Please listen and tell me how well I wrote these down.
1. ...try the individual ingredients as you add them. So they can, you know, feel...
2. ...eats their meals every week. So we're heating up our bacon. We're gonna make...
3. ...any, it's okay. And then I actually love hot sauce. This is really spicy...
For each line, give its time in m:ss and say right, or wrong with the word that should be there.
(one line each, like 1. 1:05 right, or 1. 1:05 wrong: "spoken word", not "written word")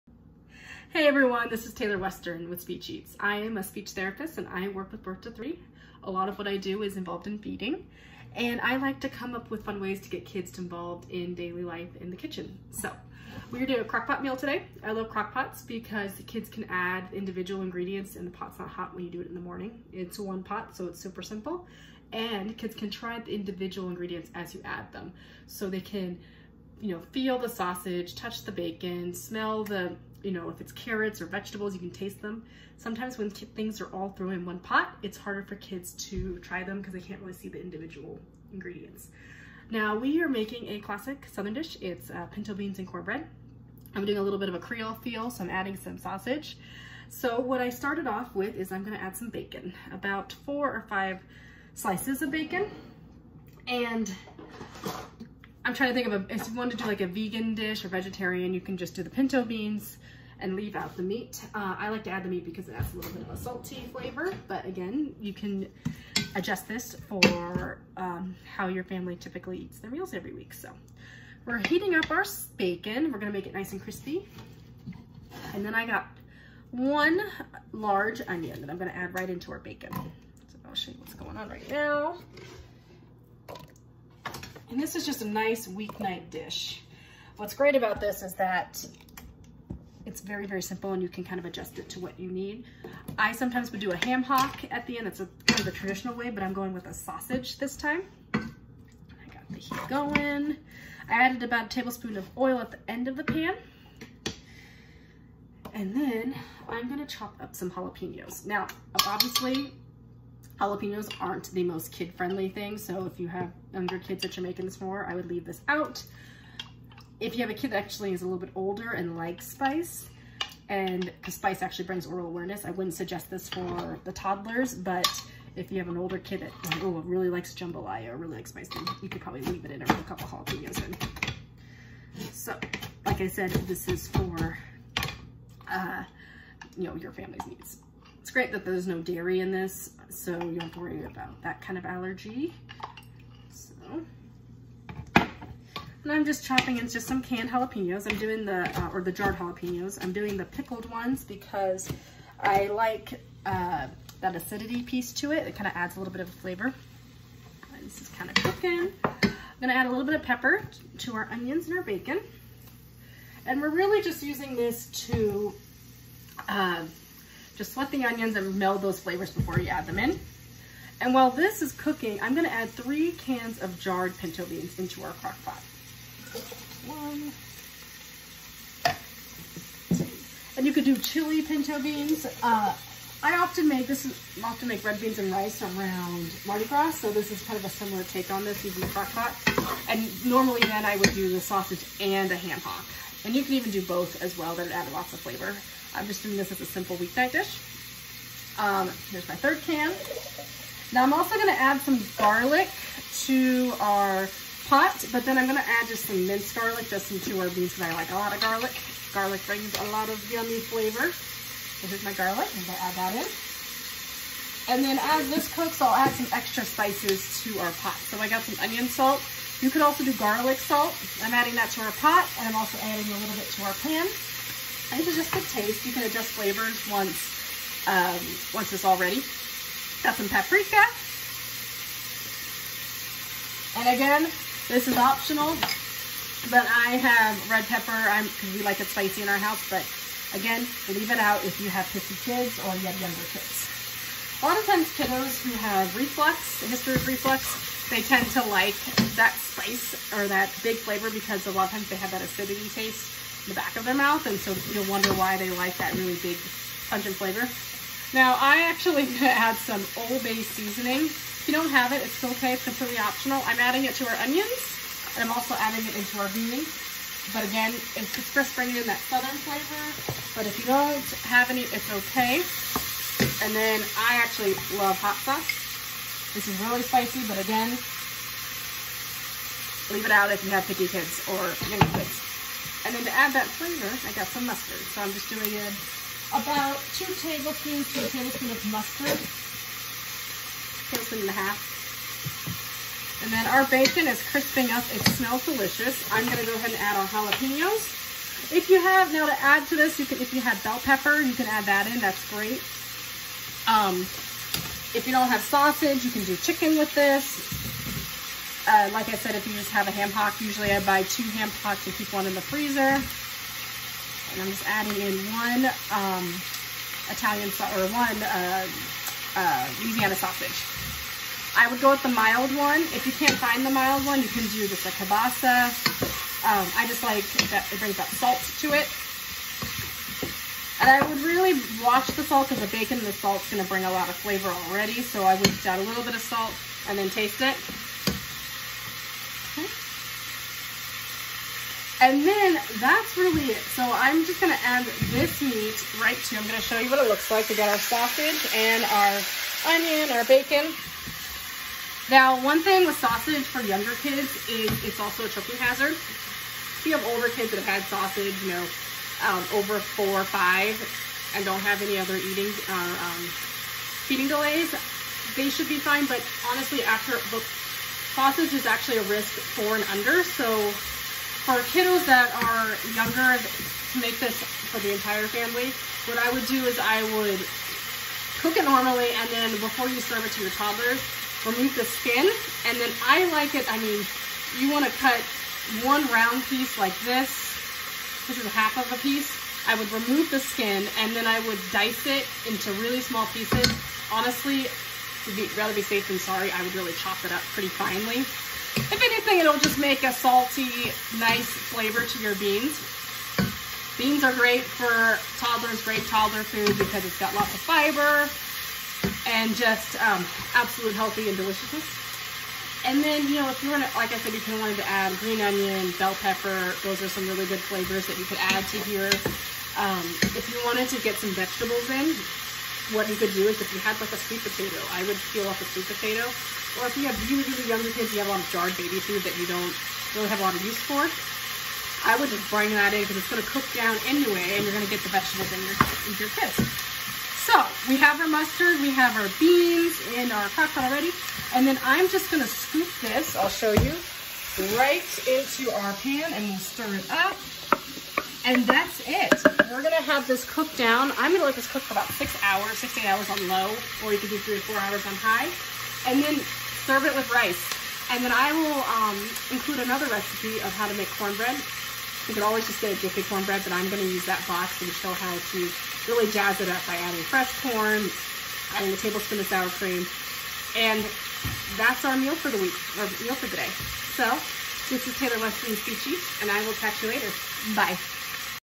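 1. 0:22 right
2. 1:09 right
3. 4:31 right.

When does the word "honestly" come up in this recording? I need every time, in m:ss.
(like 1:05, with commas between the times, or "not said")
6:06, 6:34.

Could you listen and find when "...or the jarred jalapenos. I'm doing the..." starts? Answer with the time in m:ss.
2:28.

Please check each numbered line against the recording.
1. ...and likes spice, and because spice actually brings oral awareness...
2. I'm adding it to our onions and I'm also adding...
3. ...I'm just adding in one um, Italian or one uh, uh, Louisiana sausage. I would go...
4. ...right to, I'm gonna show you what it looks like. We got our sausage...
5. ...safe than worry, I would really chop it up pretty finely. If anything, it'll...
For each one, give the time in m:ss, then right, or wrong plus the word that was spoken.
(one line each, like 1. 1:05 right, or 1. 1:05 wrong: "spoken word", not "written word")
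1. 1:58 right
2. 4:23 right
3. 5:14 right
4. 5:46 right
5. 6:35 wrong: "sorry", not "worry".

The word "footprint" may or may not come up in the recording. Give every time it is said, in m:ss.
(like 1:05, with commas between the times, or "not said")
not said.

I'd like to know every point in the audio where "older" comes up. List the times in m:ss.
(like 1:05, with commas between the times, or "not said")
1:58, 2:05, 5:57.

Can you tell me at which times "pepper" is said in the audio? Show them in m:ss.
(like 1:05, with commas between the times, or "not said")
2:40, 3:57, 5:00, 6:56.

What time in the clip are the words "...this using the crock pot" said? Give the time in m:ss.
3:08.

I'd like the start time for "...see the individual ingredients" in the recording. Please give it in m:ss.
0:37.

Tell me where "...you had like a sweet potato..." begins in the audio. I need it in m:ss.
7:03.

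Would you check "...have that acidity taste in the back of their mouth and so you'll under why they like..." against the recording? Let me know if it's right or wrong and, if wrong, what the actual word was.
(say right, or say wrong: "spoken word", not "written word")
wrong: "wonder", not "under".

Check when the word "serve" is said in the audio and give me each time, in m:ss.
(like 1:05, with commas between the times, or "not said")
6:20, 7:36.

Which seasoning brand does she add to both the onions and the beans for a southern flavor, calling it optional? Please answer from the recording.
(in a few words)
Old Bay.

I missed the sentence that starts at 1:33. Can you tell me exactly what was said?
I sometimes would do a ham hock at the end.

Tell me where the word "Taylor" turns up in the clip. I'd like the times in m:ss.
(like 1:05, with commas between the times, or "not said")
0:01, 7:55.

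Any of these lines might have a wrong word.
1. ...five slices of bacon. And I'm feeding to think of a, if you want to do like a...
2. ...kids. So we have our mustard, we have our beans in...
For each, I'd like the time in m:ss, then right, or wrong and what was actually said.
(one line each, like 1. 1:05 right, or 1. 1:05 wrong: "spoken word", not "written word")
1. 0:50 wrong: "trying", not "feeding"
2. 7:16 right.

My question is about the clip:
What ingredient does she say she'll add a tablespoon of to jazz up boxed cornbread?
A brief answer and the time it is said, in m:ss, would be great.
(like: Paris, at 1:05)
sour cream, at 7:49.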